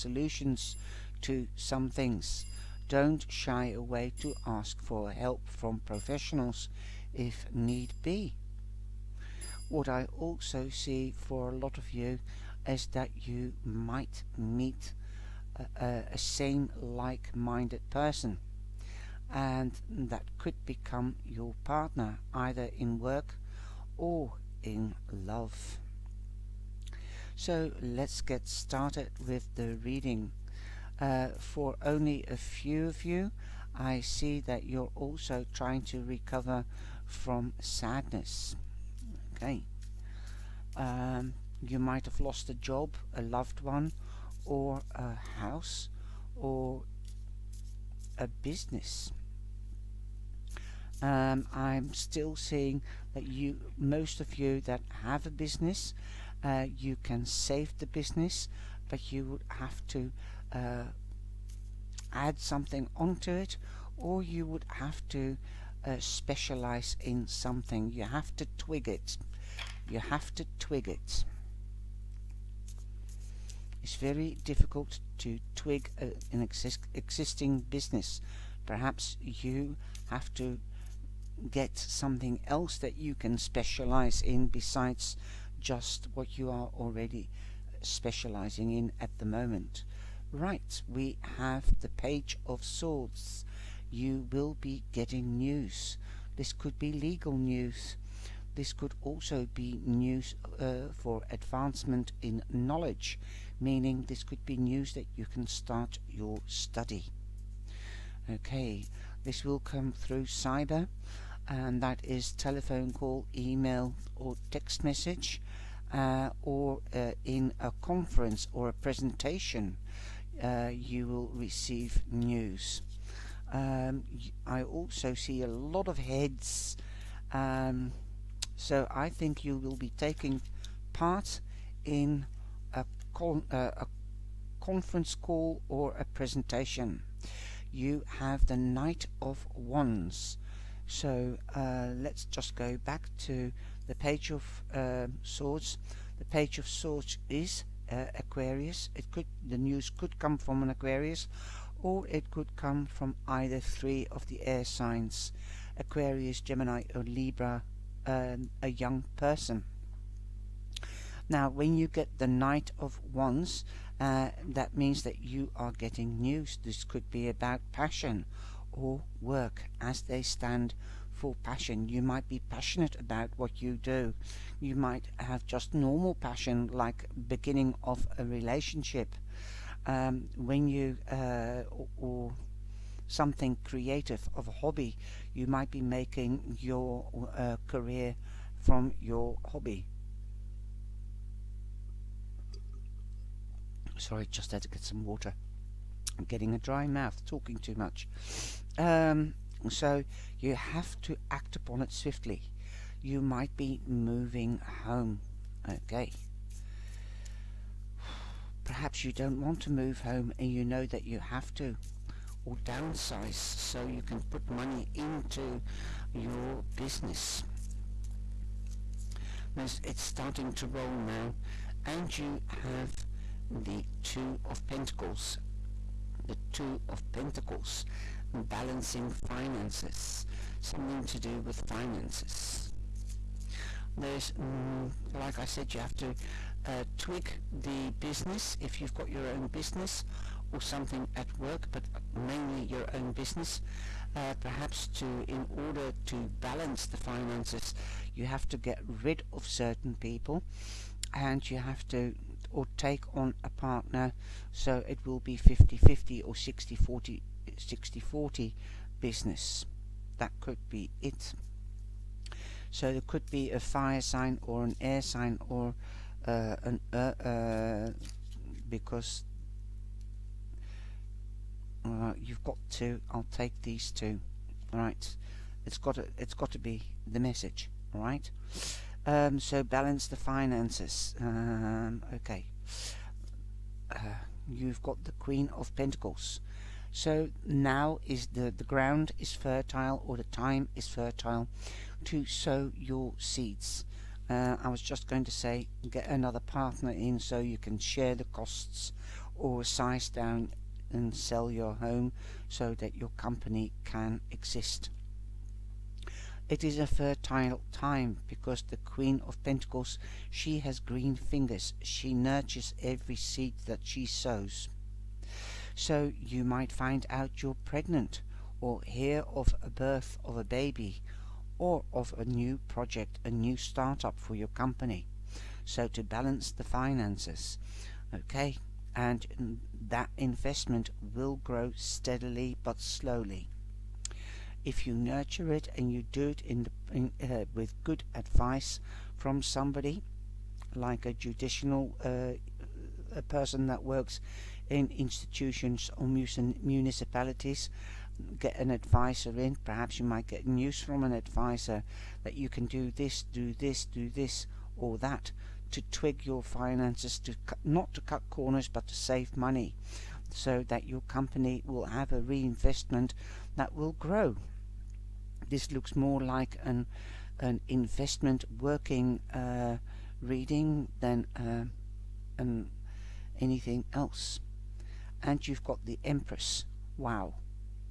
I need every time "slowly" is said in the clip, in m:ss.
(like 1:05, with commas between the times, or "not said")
5:32.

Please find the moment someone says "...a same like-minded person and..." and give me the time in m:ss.
0:16.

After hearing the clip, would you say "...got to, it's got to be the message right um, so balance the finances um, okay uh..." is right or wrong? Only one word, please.
right.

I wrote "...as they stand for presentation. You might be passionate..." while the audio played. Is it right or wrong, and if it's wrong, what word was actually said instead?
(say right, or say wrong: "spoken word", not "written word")
wrong: "passion", not "presentation".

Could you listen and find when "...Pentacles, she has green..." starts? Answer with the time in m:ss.
5:09.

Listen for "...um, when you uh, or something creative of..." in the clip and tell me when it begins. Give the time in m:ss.
2:59.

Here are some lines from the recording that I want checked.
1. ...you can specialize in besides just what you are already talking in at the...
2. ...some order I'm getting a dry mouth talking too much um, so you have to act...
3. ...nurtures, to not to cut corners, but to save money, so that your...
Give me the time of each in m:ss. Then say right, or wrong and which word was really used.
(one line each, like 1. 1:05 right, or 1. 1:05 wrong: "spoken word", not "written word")
1. 1:22 wrong: "specializing", not "talking"
2. 3:14 wrong: "water", not "order"
3. 5:56 wrong: "finances", not "nurtures".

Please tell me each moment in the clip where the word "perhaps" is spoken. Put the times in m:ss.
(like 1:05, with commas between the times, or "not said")
1:18, 3:28, 4:04, 5:49.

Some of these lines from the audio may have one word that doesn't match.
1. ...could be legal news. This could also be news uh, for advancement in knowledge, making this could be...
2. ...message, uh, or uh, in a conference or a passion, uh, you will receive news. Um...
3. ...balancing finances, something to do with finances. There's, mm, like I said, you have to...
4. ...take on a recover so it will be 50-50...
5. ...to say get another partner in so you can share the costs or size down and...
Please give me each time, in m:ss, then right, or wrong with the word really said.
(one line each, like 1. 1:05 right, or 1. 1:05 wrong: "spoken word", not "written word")
1. 1:36 wrong: "meaning", not "making"
2. 1:54 wrong: "presentation", not "passion"
3. 3:48 right
4. 4:12 wrong: "partner", not "recover"
5. 4:55 right.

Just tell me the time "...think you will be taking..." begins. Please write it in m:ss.
2:09.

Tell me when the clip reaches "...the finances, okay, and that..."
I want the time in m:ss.
5:26.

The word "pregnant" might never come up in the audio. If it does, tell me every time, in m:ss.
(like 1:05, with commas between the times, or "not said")
5:17.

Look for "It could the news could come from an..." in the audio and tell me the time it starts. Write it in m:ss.
2:28.